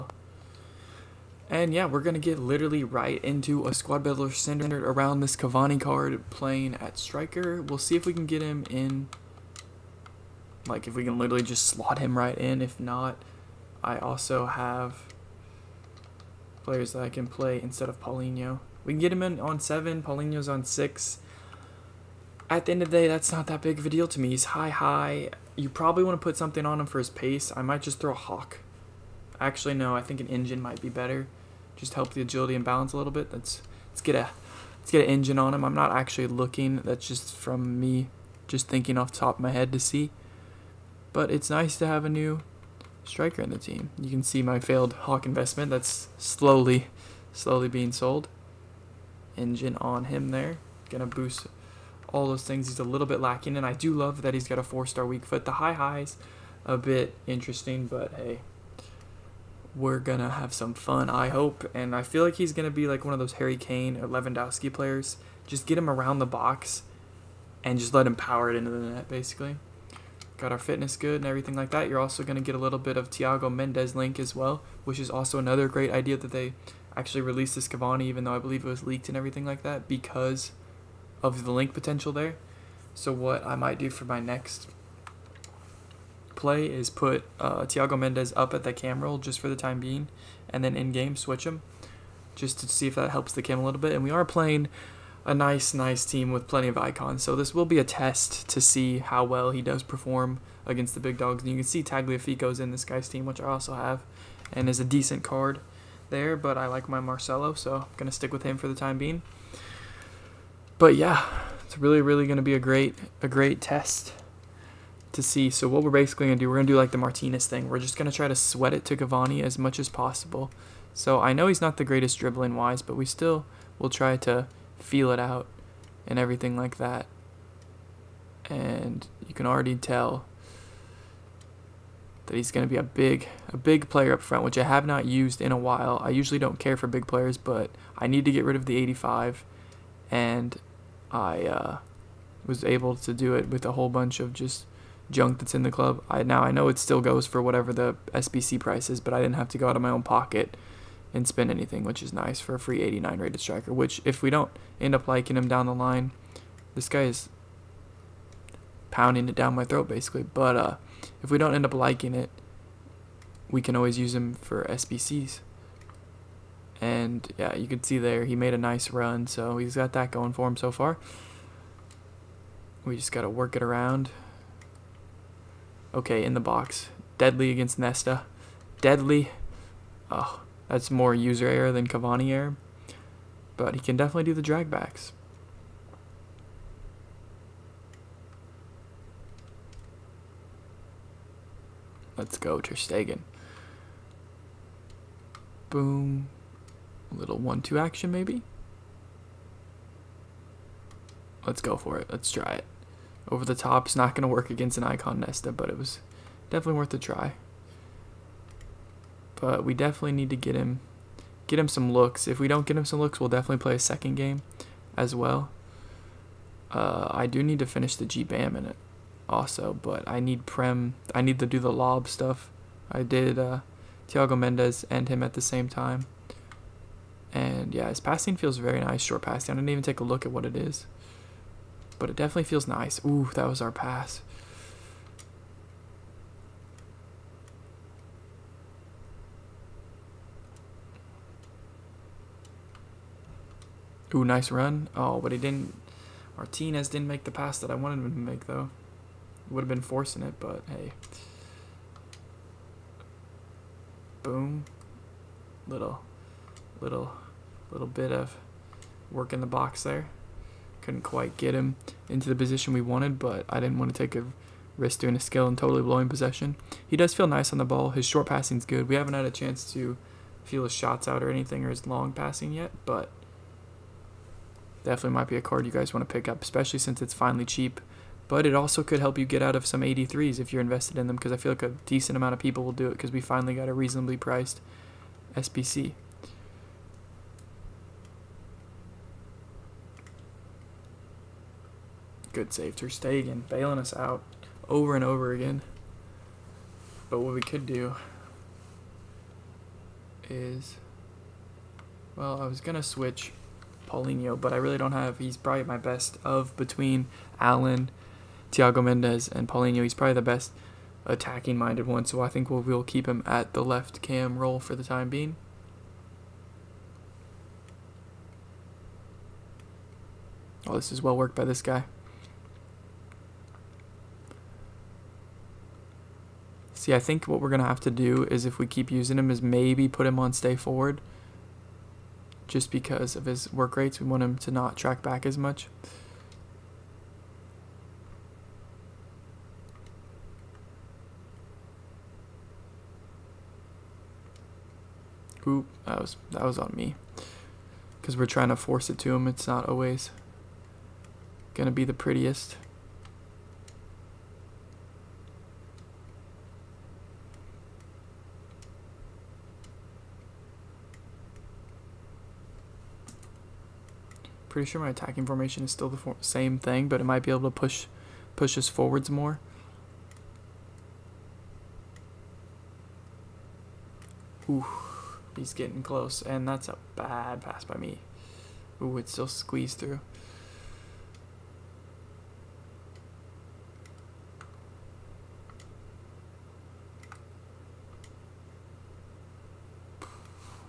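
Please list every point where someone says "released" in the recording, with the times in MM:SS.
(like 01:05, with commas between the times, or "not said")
01:17.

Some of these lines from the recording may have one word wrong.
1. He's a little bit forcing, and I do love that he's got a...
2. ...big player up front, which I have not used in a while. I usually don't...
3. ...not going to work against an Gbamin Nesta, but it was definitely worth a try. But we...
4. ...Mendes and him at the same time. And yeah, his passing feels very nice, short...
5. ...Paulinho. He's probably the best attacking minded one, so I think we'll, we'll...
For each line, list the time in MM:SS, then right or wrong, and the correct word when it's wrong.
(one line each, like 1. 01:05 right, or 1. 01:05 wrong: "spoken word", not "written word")
1. 00:52 wrong: "lacking", not "forcing"
2. 02:13 right
3. 03:23 wrong: "Icon", not "Gbamin"
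4. 03:44 right
5. 05:09 right.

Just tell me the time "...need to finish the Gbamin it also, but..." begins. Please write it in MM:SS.
03:37.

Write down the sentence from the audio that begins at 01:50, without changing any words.
But yeah, it's really, really going to be a great, a great test to see.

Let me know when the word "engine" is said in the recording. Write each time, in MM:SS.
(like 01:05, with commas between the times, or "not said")
00:30, 00:35, 00:49.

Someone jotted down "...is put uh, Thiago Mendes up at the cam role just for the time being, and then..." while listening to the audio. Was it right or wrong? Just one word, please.
right.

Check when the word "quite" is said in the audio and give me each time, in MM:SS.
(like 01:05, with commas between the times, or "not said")
04:21.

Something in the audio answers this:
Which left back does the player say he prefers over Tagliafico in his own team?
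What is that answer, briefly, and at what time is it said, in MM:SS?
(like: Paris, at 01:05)
Marcelo, at 01:46.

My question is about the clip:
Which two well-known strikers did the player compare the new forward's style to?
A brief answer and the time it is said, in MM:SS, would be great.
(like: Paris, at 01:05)
Harry Kane or Lewandowski, at 01:03.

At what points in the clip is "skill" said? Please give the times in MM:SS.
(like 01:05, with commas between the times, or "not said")
04:25.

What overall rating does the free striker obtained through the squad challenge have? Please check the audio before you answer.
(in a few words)
89.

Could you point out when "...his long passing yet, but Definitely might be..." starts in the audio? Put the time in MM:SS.
04:31.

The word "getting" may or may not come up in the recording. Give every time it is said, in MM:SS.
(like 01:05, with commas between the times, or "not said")
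06:15.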